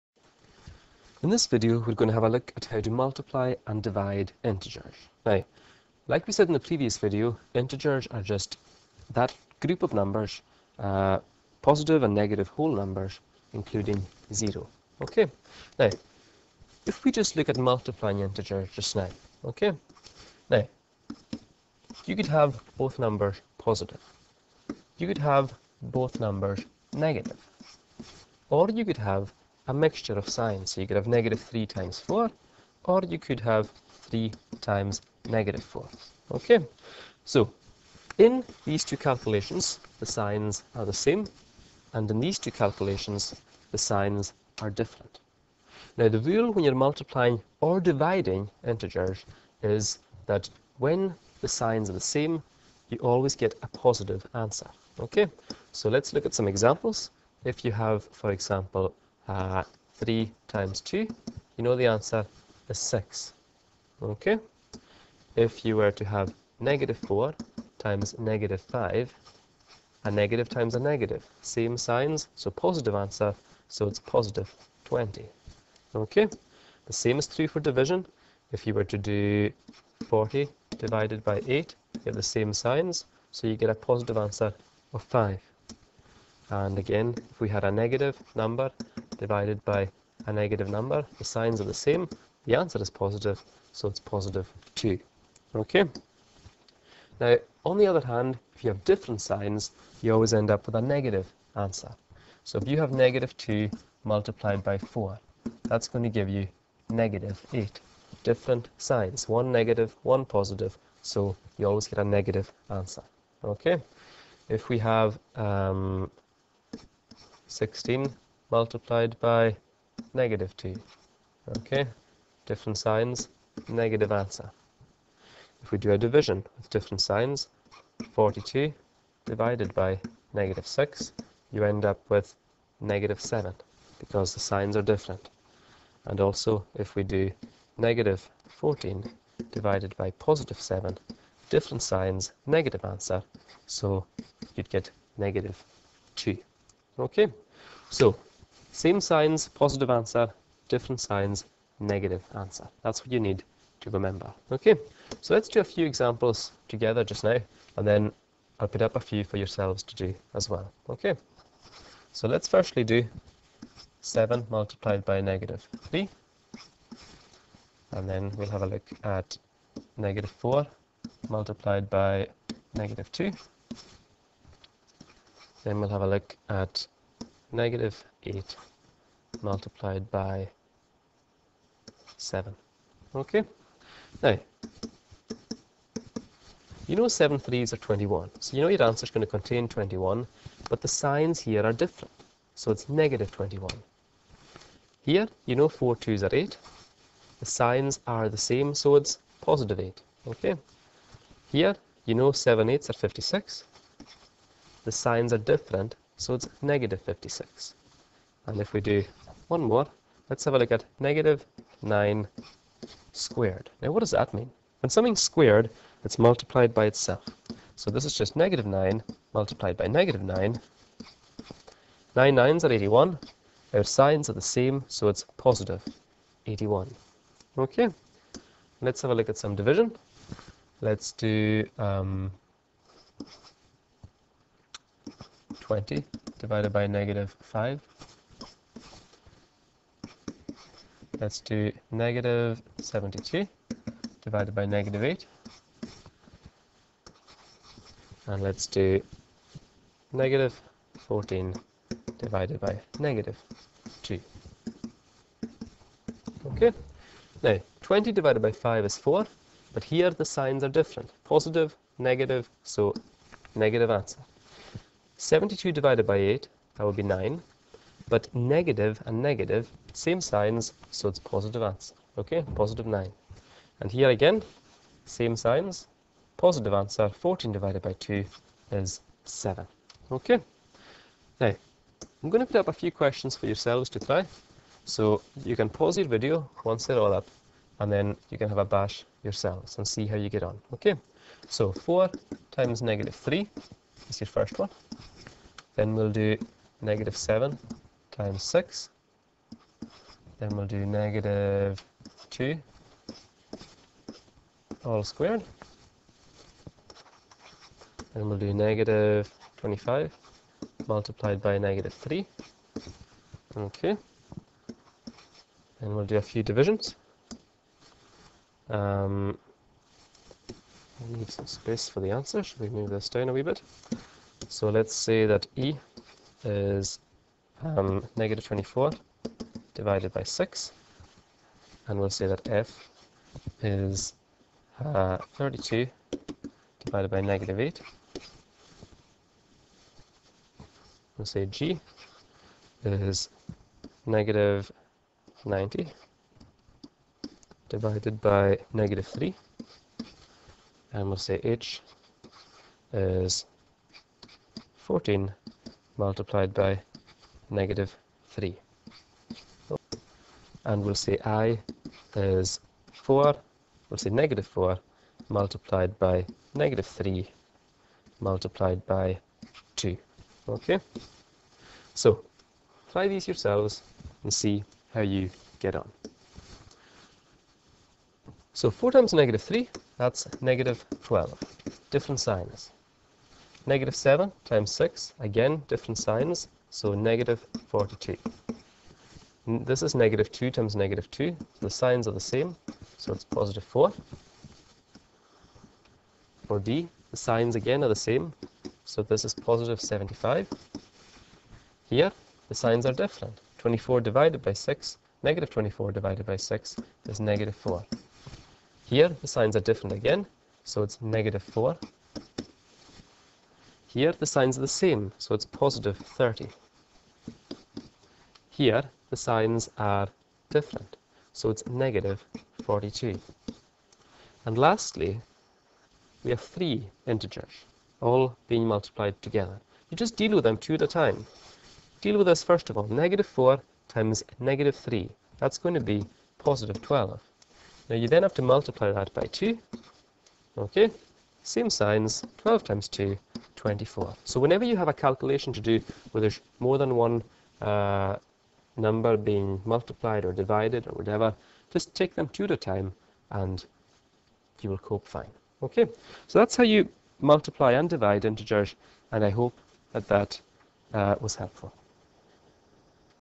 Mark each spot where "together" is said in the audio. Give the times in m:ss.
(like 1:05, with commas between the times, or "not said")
2:36, 7:09.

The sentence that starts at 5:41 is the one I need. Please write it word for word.
We'll say G is negative 90 divided by negative 3.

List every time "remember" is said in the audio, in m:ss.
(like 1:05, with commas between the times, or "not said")
2:33.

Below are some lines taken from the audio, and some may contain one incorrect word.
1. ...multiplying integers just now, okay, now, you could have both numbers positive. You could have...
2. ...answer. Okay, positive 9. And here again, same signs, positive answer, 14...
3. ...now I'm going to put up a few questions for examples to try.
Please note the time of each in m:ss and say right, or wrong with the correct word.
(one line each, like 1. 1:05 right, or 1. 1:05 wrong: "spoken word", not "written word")
1. 0:17 right
2. 4:31 right
3. 4:41 wrong: "yourselves", not "examples".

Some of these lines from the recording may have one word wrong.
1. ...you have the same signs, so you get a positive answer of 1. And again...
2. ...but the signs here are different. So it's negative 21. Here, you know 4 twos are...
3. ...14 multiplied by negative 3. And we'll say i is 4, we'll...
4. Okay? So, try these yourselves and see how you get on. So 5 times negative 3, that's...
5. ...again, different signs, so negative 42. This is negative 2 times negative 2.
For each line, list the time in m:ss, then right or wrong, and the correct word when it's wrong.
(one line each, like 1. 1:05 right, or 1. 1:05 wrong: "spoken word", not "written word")
1. 1:21 wrong: "5", not "1"
2. 3:10 right
3. 5:54 right
4. 6:10 wrong: "4", not "5"
5. 6:25 right.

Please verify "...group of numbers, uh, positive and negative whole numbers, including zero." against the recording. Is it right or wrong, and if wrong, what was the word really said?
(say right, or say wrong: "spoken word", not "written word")
right.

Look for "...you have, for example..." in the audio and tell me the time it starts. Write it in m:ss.
0:57.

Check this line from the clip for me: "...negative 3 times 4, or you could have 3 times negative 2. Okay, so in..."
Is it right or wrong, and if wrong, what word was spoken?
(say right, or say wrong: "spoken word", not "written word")
wrong: "4", not "2".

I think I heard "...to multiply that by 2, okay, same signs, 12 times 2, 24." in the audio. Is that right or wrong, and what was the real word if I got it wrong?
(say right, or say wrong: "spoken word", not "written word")
right.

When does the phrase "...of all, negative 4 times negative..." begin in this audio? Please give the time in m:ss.
7:12.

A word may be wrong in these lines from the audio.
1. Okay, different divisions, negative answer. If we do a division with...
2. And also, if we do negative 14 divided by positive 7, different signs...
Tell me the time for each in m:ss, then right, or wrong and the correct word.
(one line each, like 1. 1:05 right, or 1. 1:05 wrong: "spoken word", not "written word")
1. 2:01 wrong: "signs", not "divisions"
2. 2:16 right.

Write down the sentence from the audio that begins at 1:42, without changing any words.
So if you have negative 2 multiplied by 4, that's going to give you negative 8.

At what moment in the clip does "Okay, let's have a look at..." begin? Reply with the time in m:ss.
3:47.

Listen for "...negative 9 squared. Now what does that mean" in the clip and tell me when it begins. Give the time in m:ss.
3:30.